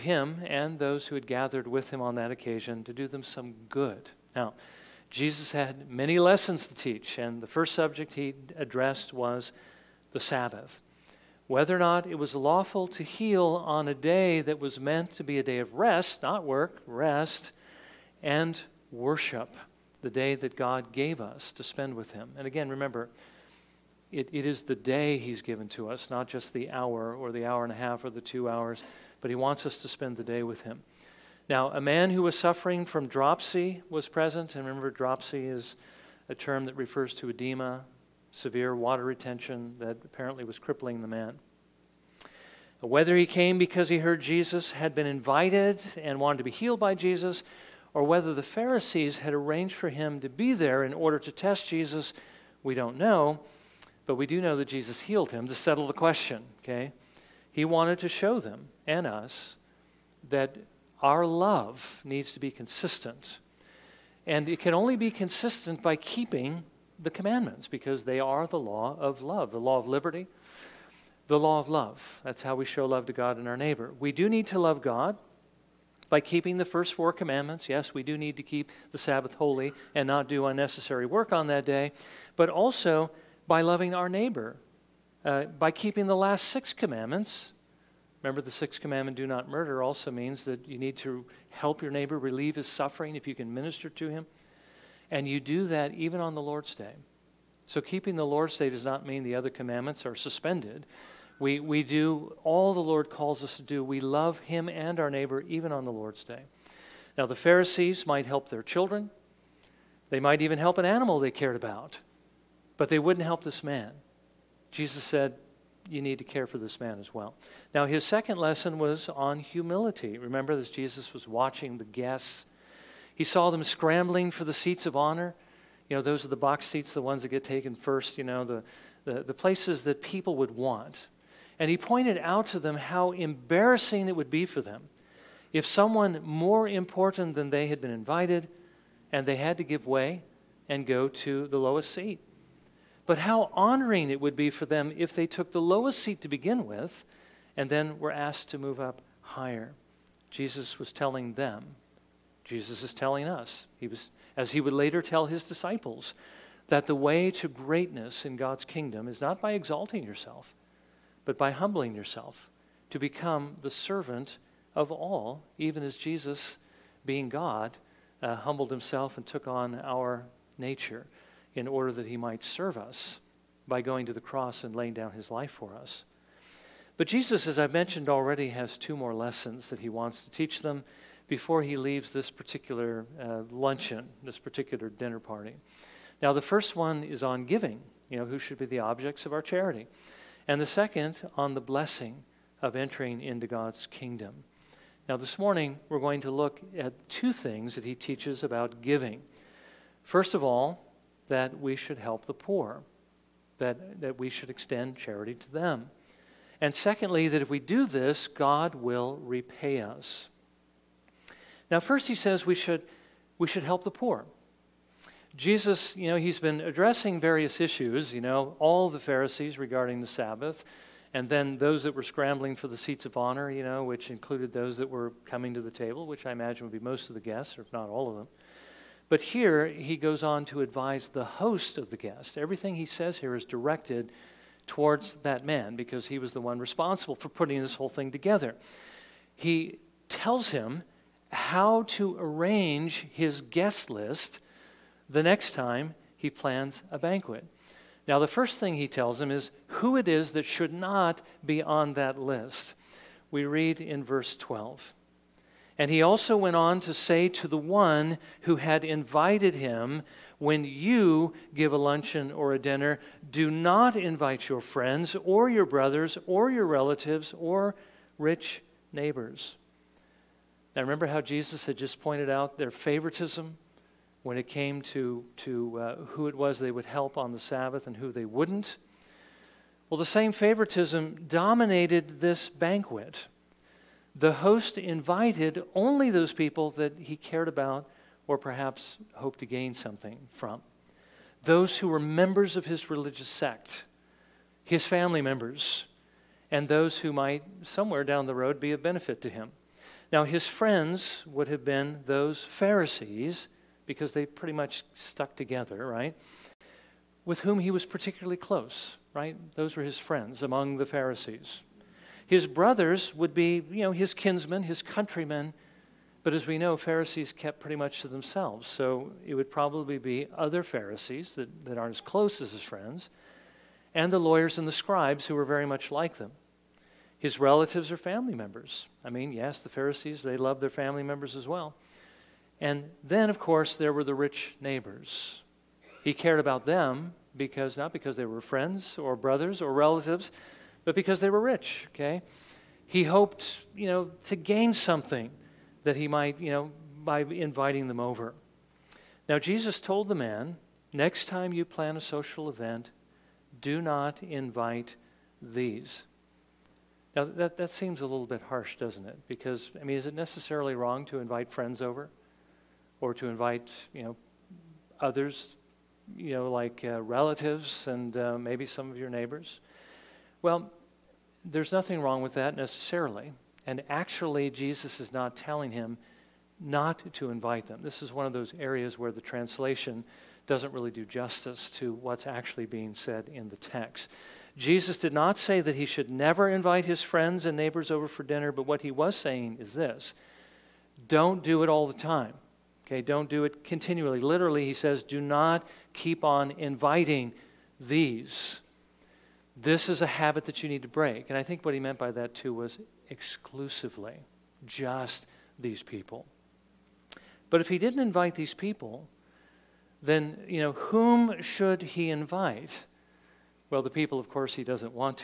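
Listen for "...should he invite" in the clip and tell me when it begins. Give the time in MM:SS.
06:51.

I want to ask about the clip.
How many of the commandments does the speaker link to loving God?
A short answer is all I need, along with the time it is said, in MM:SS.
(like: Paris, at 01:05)
4, at 01:16.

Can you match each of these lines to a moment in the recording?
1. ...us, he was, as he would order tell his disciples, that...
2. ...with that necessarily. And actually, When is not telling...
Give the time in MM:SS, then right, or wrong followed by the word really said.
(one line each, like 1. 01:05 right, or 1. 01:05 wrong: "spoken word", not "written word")
1. 02:33 wrong: "later", not "order"
2. 06:12 wrong: "Jesus", not "When".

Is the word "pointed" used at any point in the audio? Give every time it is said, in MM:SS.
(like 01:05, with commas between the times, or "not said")
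02:11, 04:32.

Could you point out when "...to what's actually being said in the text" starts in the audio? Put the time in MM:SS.
06:21.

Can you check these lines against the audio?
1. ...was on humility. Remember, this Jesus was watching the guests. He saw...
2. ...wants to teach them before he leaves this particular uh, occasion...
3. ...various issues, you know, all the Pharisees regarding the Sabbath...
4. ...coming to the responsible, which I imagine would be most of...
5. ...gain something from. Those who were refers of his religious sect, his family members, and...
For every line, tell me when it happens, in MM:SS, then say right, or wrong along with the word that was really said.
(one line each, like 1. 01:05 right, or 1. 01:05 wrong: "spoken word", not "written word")
1. 01:58 right
2. 02:59 wrong: "luncheon", not "occasion"
3. 03:37 right
4. 03:45 wrong: "table", not "responsible"
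5. 04:49 wrong: "members", not "refers".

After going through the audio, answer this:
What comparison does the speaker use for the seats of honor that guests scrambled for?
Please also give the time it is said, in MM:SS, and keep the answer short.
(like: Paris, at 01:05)
Box seats, at 02:06.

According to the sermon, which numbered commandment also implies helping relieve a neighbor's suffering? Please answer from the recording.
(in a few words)
The sixth.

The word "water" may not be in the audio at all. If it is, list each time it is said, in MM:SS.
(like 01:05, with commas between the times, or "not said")
00:38.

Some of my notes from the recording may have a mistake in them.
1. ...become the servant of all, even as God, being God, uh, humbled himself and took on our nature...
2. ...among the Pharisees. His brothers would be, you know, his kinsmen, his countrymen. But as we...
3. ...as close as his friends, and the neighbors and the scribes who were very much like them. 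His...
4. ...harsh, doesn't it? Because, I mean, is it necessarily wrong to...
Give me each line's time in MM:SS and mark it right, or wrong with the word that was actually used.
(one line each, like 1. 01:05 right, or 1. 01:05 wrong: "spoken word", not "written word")
1. 02:42 wrong: "Jesus", not "God"
2. 05:10 right
3. 05:21 wrong: "lawyers", not "neighbors"
4. 05:58 right.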